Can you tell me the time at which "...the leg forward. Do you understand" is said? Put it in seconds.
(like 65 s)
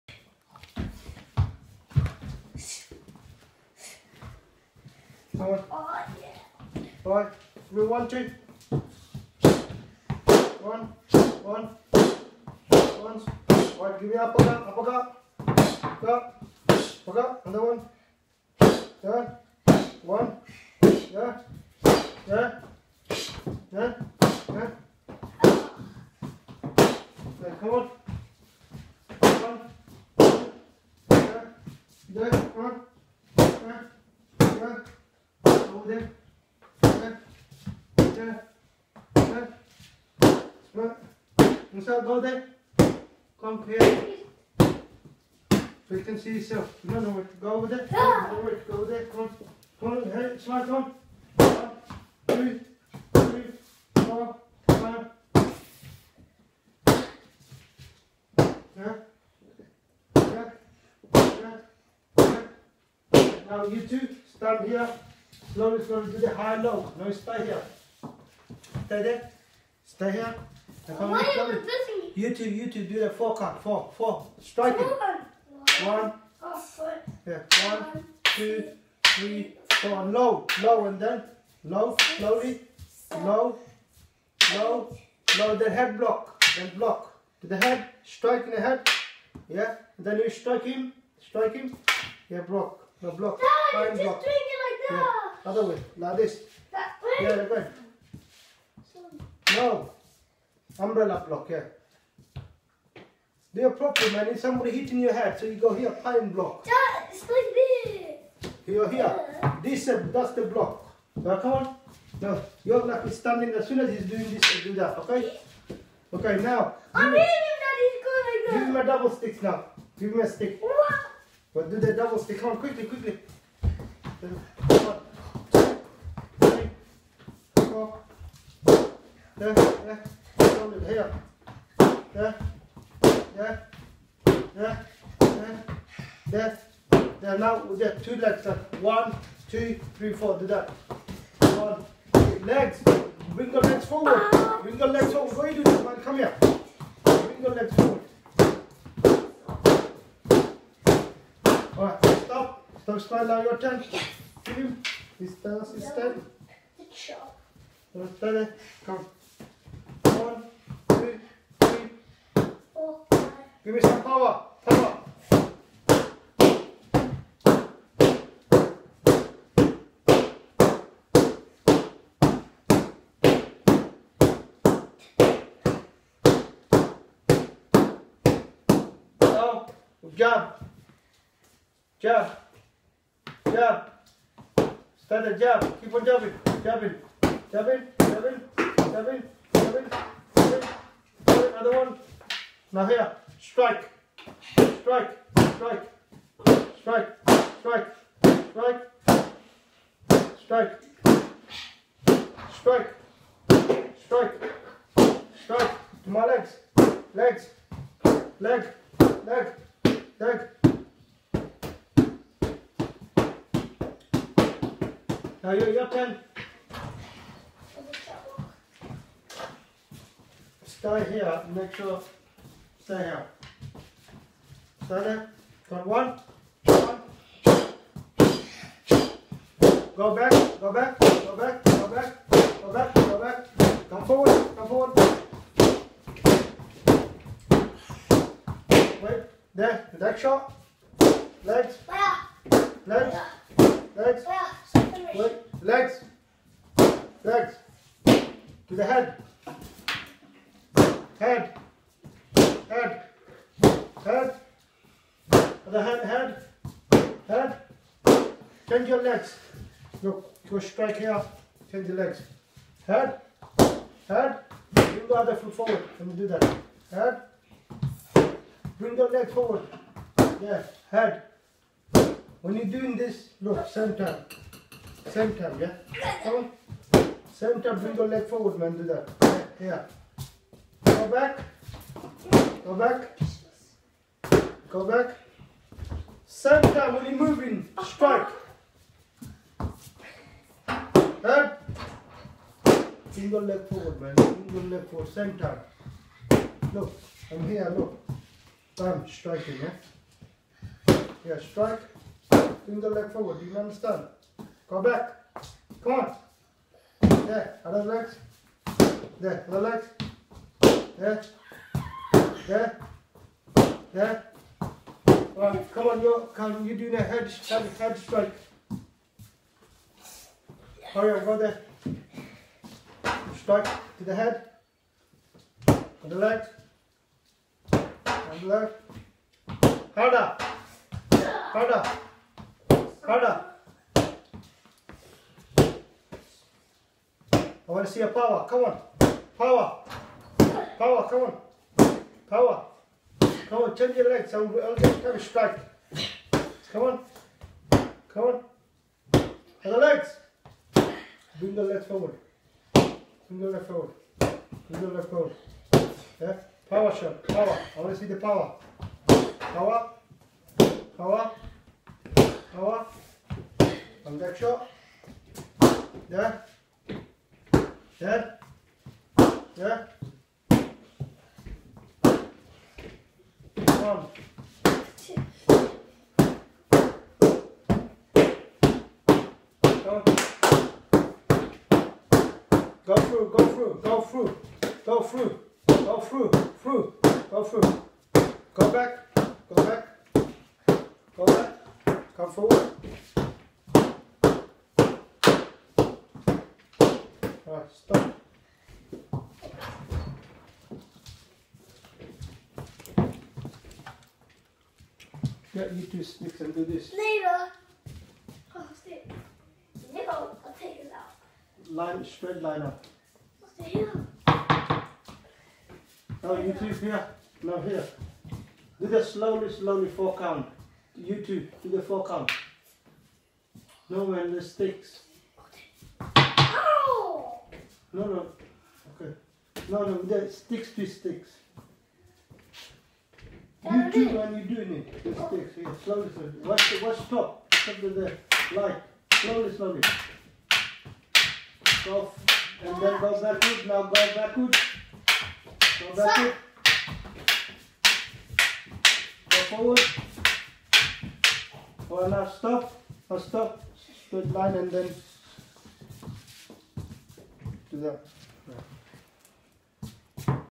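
302 s.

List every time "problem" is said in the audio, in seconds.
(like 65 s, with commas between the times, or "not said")
103 s.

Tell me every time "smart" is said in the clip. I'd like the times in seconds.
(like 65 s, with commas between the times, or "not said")
40 s, 50 s.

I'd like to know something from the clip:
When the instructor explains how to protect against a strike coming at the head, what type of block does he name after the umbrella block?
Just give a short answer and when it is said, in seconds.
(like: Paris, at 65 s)
Pine block, at 105 s.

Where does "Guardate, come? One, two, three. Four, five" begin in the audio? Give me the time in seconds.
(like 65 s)
157 s.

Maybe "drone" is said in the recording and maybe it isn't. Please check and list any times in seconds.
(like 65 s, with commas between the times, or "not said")
not said.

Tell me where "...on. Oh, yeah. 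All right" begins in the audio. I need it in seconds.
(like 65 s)
5 s.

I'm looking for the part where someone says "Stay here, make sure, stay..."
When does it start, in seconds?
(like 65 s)
220 s.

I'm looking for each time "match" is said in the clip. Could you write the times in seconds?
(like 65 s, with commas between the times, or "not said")
not said.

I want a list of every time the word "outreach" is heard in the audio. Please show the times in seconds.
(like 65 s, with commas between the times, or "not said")
not said.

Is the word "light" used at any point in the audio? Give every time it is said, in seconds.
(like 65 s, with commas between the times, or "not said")
438 s.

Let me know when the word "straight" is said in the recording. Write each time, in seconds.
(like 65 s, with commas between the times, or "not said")
412 s, 454 s.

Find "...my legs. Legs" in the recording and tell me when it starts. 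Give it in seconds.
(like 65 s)
206 s.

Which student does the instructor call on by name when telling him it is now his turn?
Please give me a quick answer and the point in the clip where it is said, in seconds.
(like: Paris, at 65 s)
Ismail, at 152 s.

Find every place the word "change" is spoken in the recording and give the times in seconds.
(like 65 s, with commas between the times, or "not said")
258 s, 343 s.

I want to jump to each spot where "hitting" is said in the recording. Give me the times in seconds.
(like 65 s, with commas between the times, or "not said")
104 s.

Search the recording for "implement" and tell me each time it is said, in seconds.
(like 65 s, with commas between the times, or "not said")
not said.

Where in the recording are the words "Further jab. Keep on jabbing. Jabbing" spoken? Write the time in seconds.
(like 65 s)
185 s.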